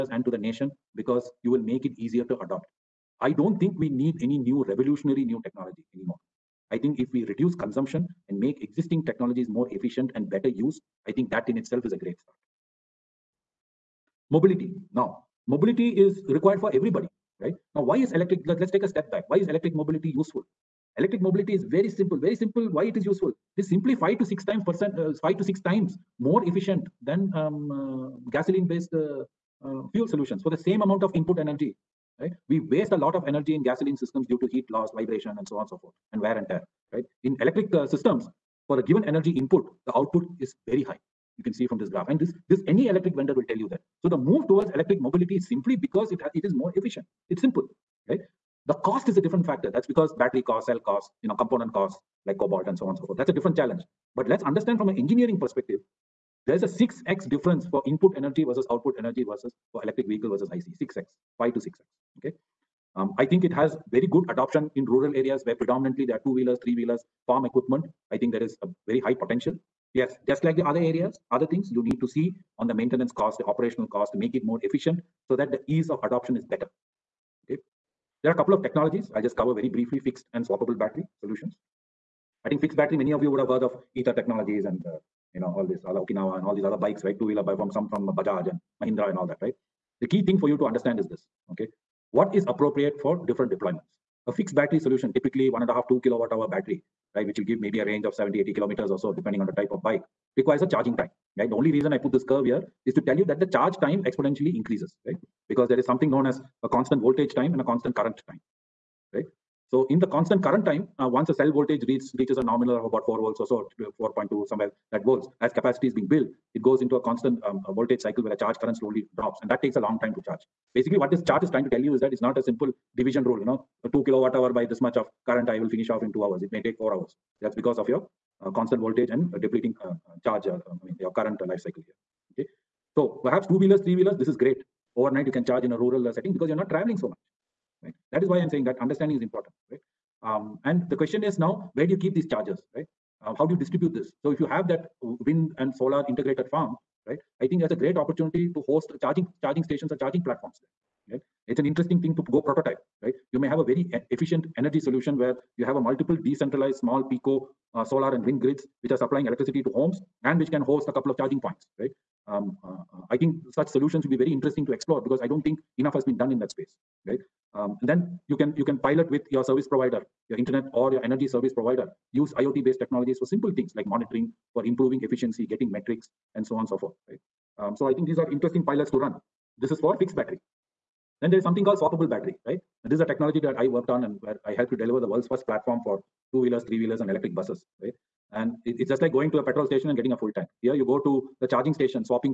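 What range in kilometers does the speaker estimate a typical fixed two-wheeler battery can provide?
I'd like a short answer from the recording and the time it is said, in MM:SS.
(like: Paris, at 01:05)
70 to 80 kilometers, at 01:38.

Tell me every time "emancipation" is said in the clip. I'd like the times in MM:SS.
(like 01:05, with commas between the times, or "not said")
not said.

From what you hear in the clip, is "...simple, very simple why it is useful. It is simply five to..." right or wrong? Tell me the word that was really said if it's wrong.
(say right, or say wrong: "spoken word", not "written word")
right.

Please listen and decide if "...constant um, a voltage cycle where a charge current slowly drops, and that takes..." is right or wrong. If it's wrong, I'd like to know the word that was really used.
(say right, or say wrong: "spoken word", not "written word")
right.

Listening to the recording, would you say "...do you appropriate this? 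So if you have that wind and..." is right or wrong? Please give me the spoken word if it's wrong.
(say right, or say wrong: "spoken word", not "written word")
wrong: "distribute", not "appropriate".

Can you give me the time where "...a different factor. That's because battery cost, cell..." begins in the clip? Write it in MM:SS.
00:49.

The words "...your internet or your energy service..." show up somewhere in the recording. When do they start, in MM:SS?
02:50.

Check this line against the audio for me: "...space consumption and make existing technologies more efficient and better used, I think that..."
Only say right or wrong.
wrong.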